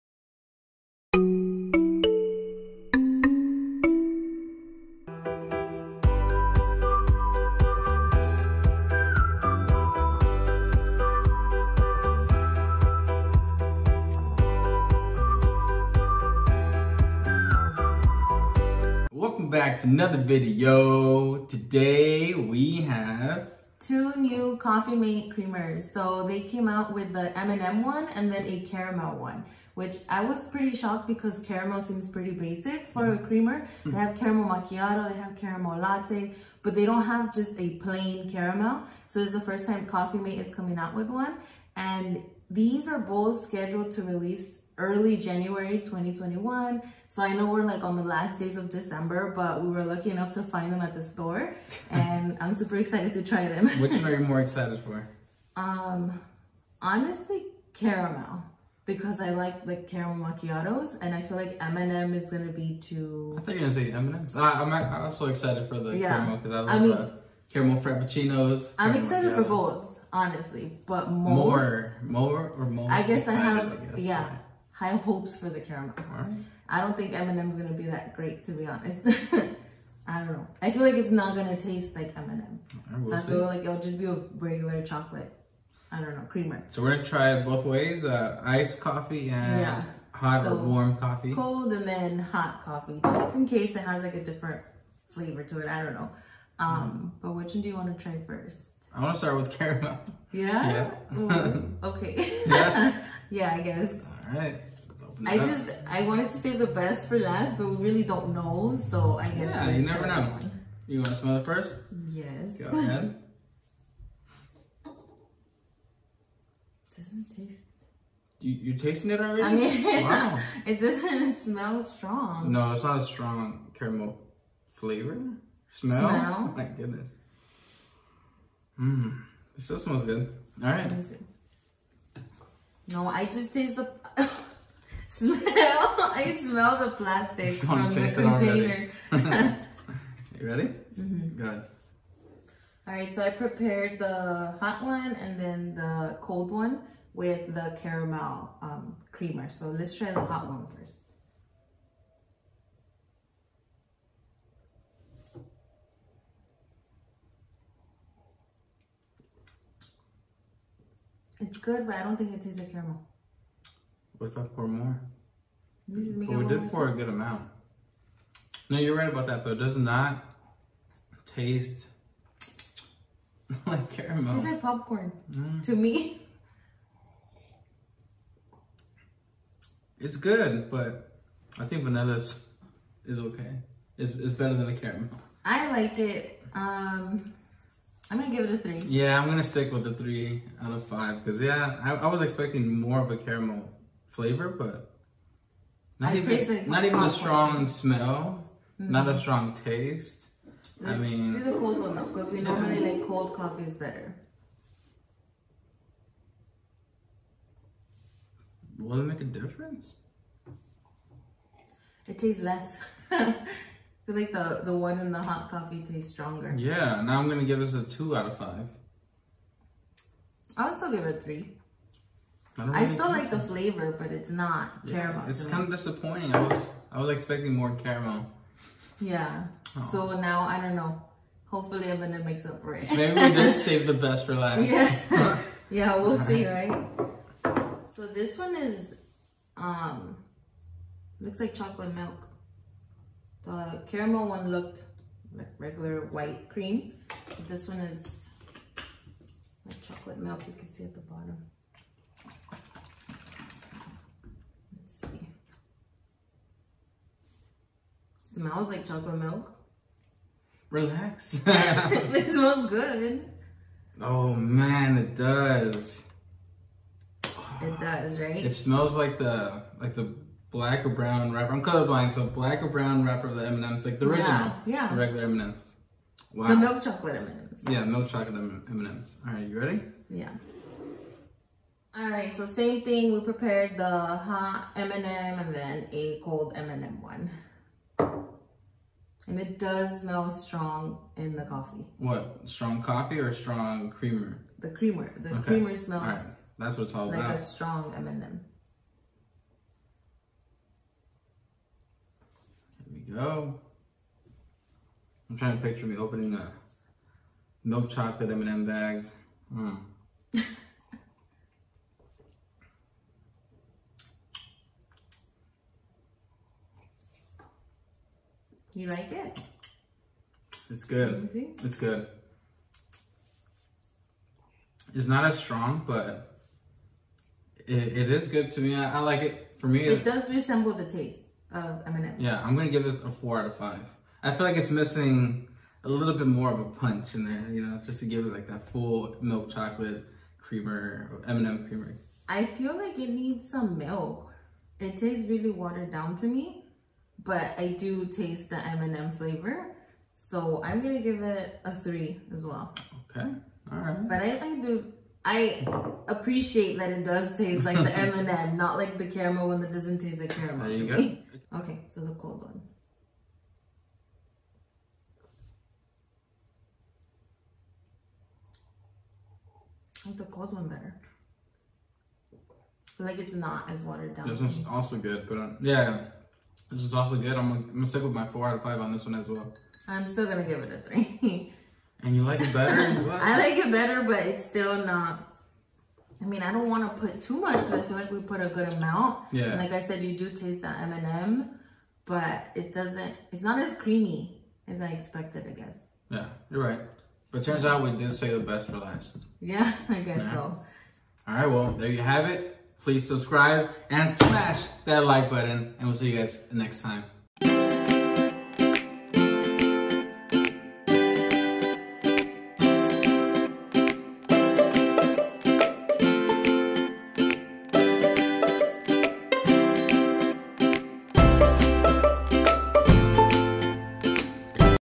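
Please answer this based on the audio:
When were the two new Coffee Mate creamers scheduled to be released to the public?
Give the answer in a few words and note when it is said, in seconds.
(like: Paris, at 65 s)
early January 2021, at 44 s.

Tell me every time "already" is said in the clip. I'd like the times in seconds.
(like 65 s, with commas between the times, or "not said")
119 s.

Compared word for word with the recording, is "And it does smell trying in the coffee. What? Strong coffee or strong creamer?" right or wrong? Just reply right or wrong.
wrong.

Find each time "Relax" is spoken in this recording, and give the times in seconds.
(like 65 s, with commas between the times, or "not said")
260 s.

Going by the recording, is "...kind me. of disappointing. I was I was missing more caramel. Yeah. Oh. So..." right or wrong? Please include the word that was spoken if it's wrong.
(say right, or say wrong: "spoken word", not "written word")
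wrong: "expecting", not "missing".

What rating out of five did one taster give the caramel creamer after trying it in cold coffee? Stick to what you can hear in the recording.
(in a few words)
2.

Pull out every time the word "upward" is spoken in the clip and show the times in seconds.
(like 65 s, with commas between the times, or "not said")
not said.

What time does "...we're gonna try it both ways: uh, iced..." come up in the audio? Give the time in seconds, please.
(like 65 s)
86 s.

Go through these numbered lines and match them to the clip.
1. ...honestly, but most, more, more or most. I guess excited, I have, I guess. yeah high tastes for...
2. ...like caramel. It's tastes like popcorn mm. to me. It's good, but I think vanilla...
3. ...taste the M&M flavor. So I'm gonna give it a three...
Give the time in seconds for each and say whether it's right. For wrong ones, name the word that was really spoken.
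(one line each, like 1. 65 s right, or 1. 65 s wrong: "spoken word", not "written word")
1. 70 s wrong: "hopes", not "tastes"
2. 173 s right
3. 348 s right.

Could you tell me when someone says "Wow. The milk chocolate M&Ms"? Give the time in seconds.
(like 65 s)
276 s.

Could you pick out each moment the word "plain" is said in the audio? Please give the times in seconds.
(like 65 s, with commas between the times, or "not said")
37 s.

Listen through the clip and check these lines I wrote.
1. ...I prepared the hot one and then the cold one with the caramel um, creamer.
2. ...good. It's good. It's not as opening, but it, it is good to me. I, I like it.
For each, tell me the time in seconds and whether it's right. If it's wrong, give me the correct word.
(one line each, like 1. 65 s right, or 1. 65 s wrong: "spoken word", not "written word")
1. 143 s right
2. 320 s wrong: "strong", not "opening".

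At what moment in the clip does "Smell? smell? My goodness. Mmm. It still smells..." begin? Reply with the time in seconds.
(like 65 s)
125 s.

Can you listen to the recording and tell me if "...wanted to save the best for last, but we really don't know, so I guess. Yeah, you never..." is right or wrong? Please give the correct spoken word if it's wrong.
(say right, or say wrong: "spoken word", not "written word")
right.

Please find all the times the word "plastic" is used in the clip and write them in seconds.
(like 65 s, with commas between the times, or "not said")
136 s.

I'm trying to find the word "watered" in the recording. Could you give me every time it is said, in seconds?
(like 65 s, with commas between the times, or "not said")
345 s, 373 s.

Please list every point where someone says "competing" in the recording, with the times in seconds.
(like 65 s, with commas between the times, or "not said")
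not said.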